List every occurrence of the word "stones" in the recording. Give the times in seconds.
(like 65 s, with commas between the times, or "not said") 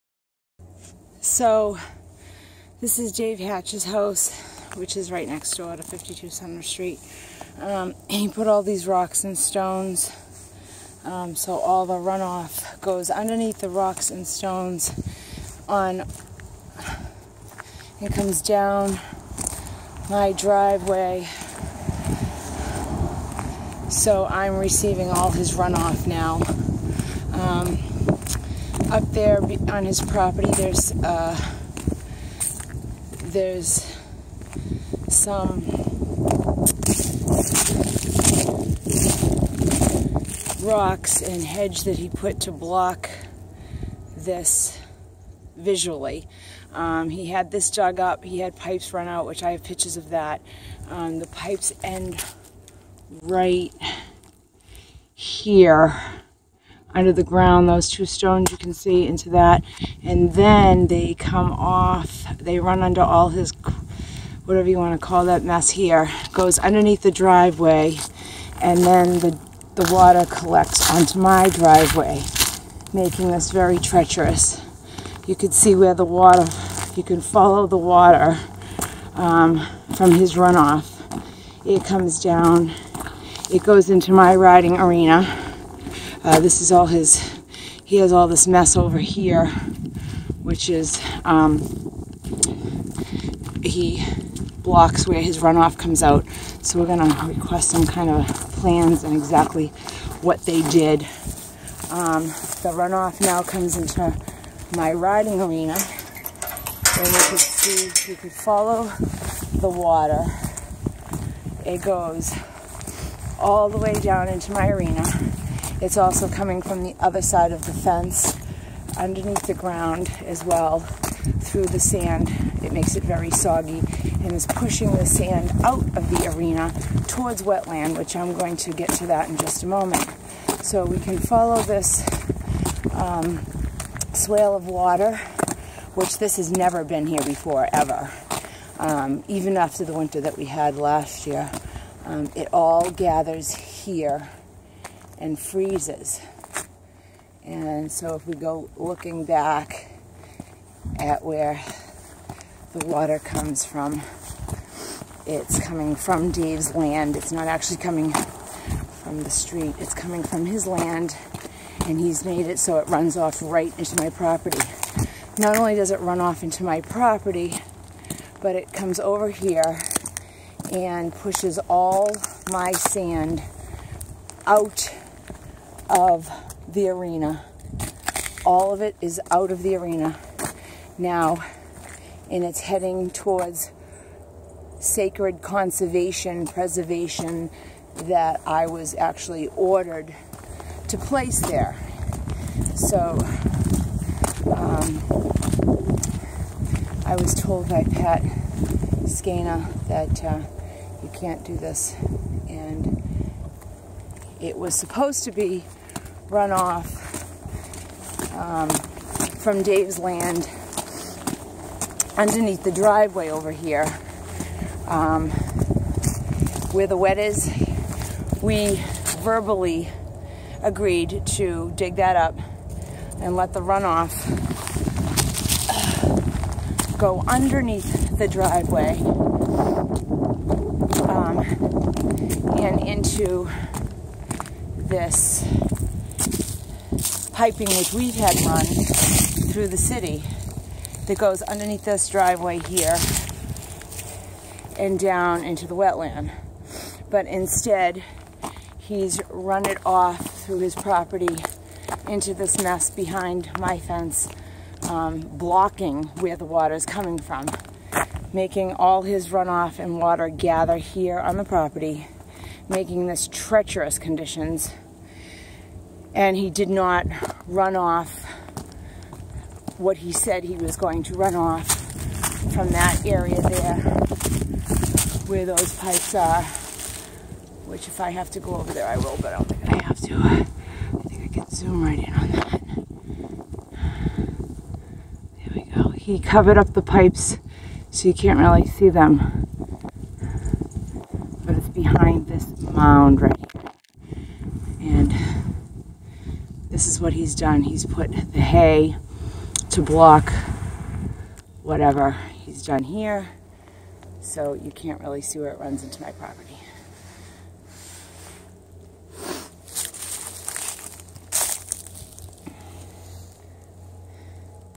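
9 s, 14 s, 58 s.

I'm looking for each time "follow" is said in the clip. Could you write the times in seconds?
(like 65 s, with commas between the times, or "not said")
77 s, 108 s, 131 s.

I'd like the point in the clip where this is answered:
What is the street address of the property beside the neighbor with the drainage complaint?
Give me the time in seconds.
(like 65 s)
5 s.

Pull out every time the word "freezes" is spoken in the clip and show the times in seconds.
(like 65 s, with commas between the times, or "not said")
145 s.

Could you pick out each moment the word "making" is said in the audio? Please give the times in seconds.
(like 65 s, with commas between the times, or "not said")
72 s, 258 s, 262 s.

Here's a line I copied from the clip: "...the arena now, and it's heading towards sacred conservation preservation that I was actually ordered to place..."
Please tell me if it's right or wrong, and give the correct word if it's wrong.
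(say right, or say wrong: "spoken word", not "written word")
right.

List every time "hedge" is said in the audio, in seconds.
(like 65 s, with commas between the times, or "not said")
41 s.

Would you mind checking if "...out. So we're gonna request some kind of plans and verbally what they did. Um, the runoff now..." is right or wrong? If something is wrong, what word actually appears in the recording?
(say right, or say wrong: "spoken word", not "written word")
wrong: "exactly", not "verbally".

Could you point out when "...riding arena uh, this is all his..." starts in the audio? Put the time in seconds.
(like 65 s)
84 s.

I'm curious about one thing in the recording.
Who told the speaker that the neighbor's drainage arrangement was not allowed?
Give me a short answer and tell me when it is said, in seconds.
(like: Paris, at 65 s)
Pat Skana, at 197 s.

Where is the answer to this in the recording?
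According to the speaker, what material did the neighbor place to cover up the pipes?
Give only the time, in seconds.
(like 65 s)
298 s.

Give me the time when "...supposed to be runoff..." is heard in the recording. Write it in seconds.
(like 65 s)
204 s.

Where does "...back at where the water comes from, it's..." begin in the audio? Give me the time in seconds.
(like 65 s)
149 s.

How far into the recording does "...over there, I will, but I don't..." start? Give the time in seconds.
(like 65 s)
278 s.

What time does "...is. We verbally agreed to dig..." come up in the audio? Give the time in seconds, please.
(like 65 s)
217 s.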